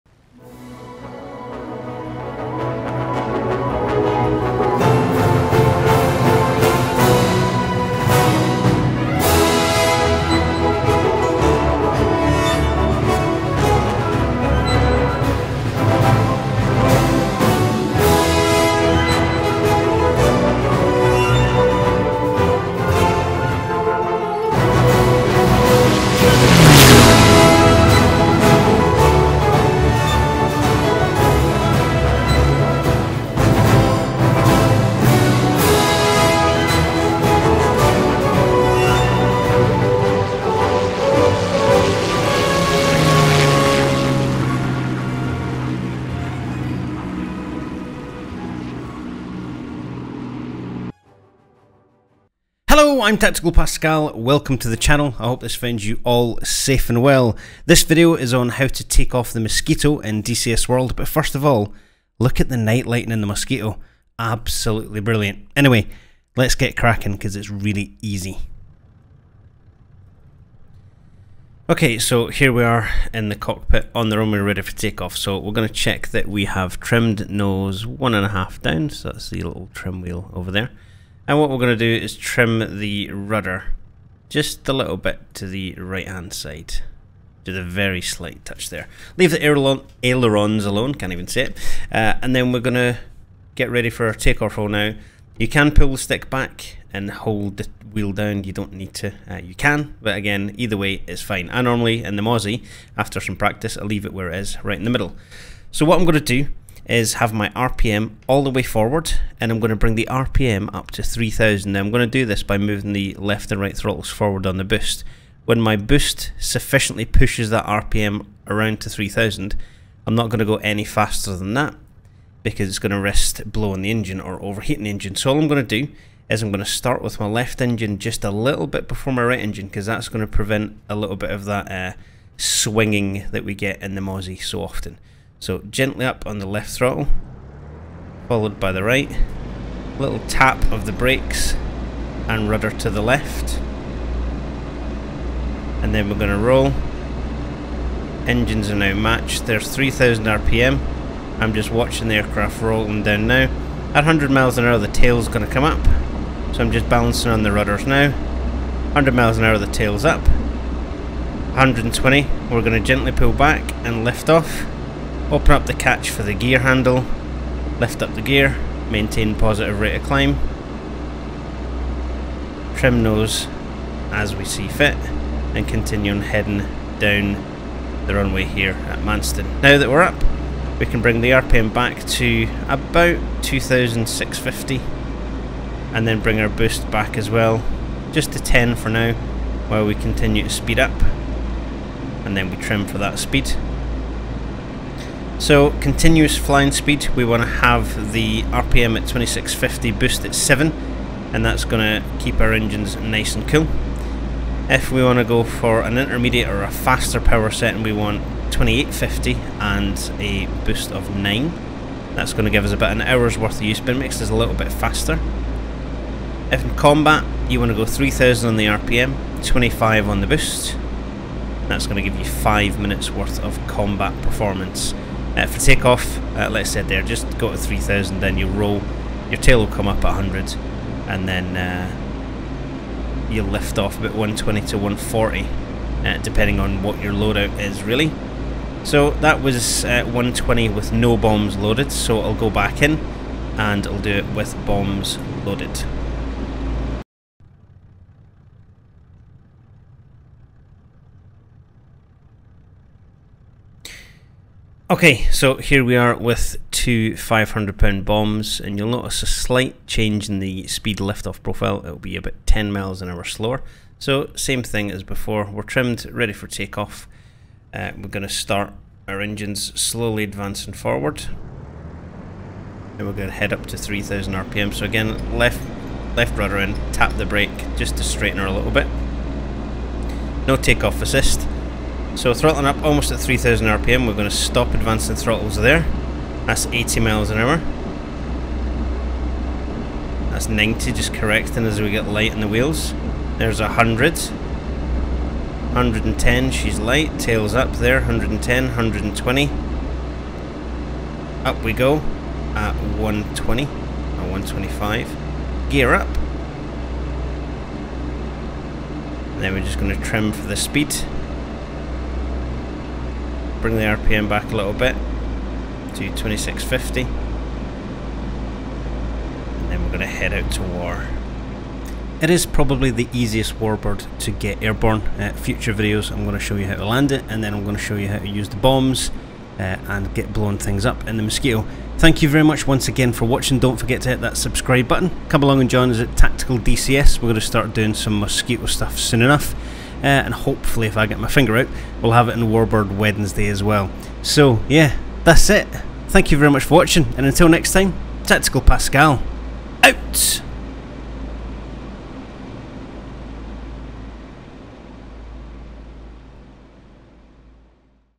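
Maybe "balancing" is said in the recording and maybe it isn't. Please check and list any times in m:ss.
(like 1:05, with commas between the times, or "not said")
2:36.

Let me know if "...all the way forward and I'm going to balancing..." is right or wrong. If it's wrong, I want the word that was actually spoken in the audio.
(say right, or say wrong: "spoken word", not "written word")
wrong: "bring", not "balancing".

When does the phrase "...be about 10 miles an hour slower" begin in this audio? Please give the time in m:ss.
4:21.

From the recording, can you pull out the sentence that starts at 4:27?
Uh, we're going to start our engines slowly advancing forward.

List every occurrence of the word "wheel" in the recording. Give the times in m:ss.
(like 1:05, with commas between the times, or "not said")
1:20, 1:37, 4:52.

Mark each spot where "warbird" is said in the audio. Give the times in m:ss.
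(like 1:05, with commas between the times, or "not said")
5:23, 5:42.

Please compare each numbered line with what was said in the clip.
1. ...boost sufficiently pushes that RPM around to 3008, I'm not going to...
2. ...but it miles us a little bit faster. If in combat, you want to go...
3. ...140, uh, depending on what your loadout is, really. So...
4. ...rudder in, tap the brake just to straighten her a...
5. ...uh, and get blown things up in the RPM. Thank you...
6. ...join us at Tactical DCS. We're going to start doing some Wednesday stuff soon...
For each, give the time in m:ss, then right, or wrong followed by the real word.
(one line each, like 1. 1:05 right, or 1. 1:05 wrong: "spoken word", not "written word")
1. 1:55 wrong: "3000", not "3008"
2. 3:33 wrong: "makes", not "miles"
3. 3:54 right
4. 4:36 right
5. 5:29 wrong: "Mosquito", not "RPM"
6. 5:35 wrong: "Mosquito", not "Wednesday".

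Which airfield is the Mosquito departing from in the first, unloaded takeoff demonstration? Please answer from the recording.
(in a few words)
Manston.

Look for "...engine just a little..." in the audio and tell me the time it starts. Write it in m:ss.
2:07.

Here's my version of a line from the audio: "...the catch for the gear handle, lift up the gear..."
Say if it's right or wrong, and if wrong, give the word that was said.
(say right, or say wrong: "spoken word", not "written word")
right.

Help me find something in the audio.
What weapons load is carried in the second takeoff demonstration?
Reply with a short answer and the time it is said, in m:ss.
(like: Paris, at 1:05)
two 500 pound bombs, at 4:16.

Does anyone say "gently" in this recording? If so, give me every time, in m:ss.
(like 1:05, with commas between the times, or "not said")
2:15, 2:42.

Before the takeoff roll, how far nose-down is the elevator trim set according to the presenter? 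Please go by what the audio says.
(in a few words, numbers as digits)
1.5.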